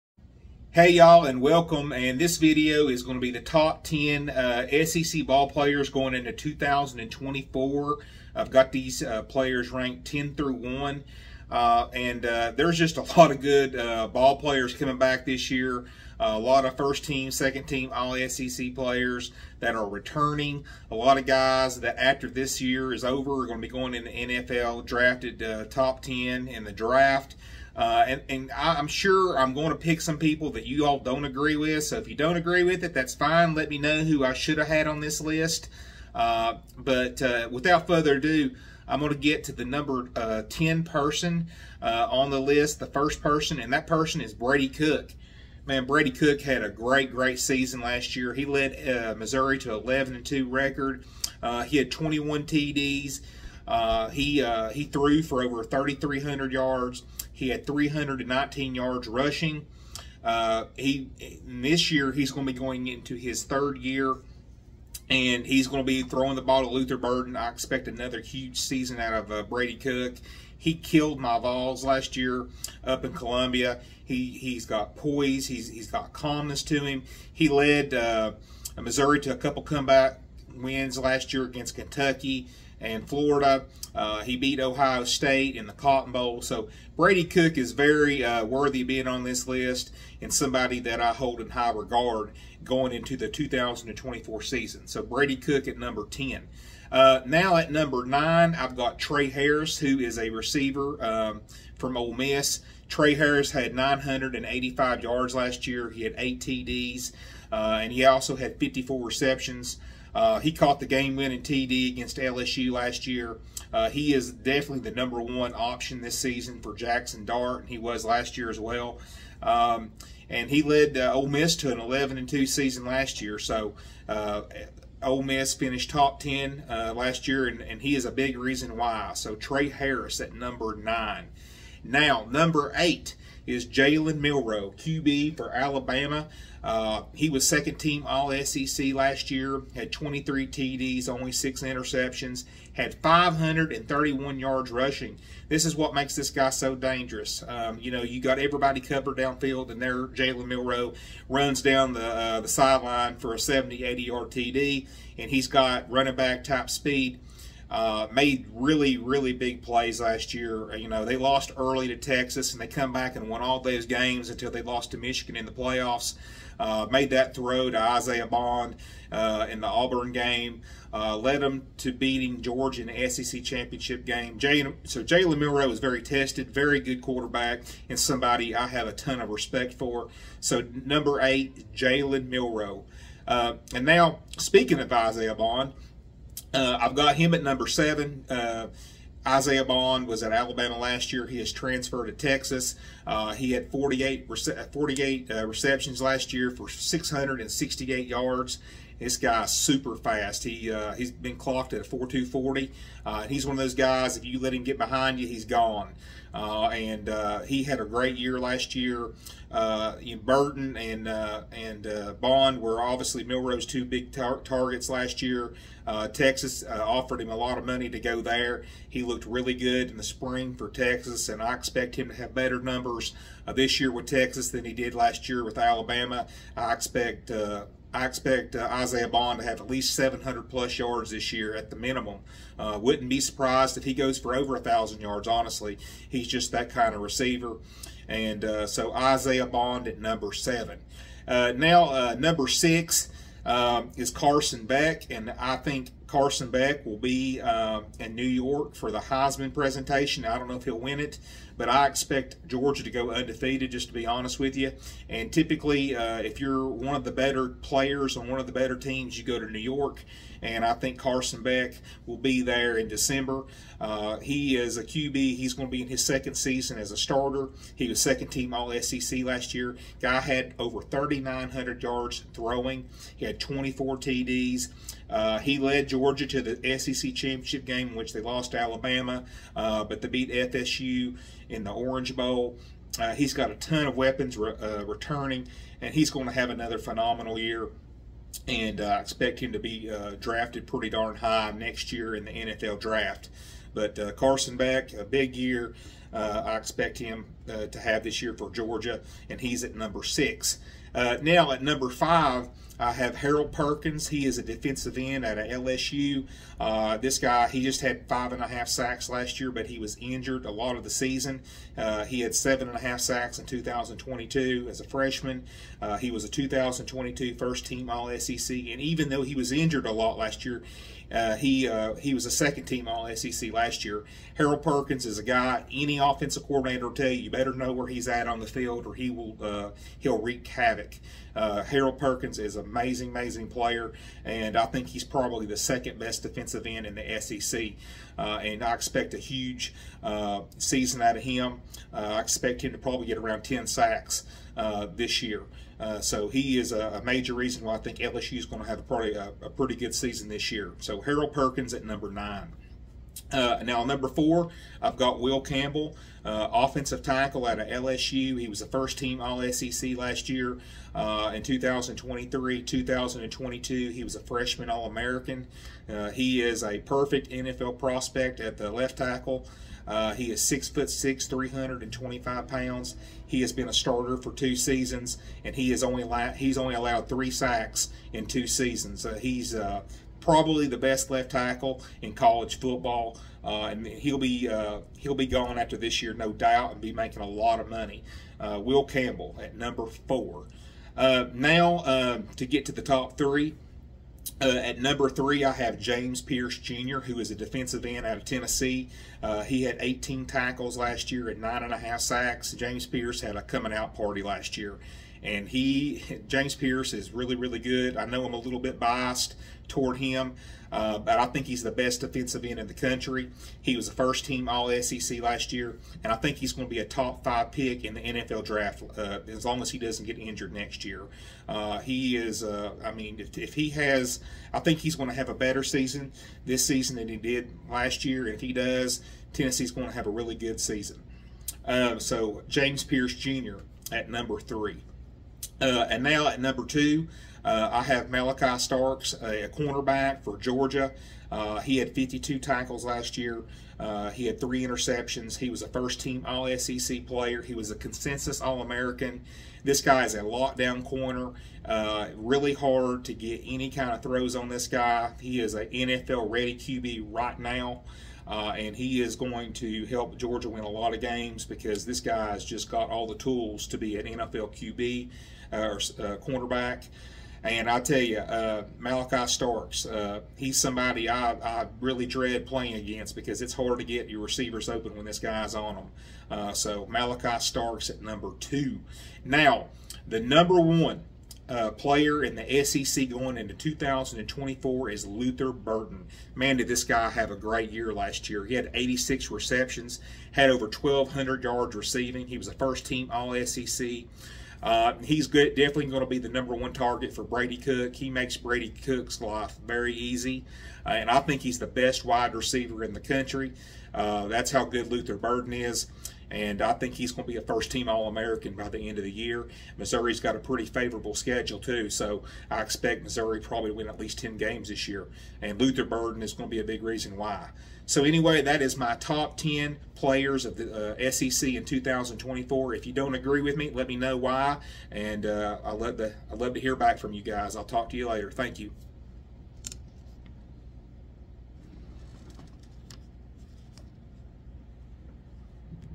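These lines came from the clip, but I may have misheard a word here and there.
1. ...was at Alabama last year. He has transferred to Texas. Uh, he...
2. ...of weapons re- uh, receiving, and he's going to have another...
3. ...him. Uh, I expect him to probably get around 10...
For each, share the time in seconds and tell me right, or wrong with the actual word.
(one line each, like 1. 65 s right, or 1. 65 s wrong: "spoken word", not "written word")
1. 190 s right
2. 283 s wrong: "returning", not "receiving"
3. 341 s right.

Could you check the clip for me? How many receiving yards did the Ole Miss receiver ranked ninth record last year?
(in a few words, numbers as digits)
985.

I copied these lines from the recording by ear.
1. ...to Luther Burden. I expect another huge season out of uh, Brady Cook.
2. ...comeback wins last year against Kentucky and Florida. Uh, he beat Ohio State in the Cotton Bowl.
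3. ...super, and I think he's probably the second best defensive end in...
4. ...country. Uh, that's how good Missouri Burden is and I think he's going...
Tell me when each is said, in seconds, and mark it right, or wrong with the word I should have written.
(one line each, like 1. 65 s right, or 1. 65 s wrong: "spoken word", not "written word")
1. 66 s right
2. 79 s right
3. 333 s wrong: "player", not "super"
4. 502 s wrong: "Luther", not "Missouri".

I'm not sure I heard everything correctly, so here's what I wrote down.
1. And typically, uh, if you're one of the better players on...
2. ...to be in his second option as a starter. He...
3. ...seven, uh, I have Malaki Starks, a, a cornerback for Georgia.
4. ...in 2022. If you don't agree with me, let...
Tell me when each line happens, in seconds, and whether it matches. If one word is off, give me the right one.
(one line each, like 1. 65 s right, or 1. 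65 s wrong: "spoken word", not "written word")
1. 255 s right
2. 265 s wrong: "season", not "option"
3. 436 s wrong: "two", not "seven"
4. 521 s wrong: "2024", not "2022".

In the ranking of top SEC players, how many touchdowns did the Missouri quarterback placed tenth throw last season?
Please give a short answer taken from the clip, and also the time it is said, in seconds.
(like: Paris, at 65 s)
21, at 51 s.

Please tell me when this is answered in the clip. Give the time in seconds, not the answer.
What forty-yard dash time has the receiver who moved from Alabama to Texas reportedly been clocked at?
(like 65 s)
201 s.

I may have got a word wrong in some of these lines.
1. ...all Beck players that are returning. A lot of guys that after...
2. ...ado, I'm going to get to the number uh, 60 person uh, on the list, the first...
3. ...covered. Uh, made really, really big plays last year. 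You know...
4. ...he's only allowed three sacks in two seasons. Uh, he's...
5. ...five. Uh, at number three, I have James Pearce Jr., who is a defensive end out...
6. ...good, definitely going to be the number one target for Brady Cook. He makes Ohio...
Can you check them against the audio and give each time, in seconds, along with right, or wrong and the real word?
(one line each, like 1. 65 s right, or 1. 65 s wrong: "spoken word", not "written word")
1. 17 s wrong: "SEC", not "Beck"
2. 38 s wrong: "10", not "60"
3. 156 s wrong: "speed", not "covered"
4. 376 s right
5. 393 s wrong: "three", not "five"
6. 495 s wrong: "Brady", not "Ohio".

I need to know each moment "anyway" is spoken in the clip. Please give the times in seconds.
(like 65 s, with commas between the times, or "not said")
518 s.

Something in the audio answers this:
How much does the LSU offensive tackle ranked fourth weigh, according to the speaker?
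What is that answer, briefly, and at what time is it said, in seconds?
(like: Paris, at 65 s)
325 pounds, at 371 s.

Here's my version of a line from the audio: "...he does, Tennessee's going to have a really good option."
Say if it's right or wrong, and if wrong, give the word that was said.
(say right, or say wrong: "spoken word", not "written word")
wrong: "season", not "option".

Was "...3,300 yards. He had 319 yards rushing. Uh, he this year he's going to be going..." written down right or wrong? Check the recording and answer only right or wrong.
right.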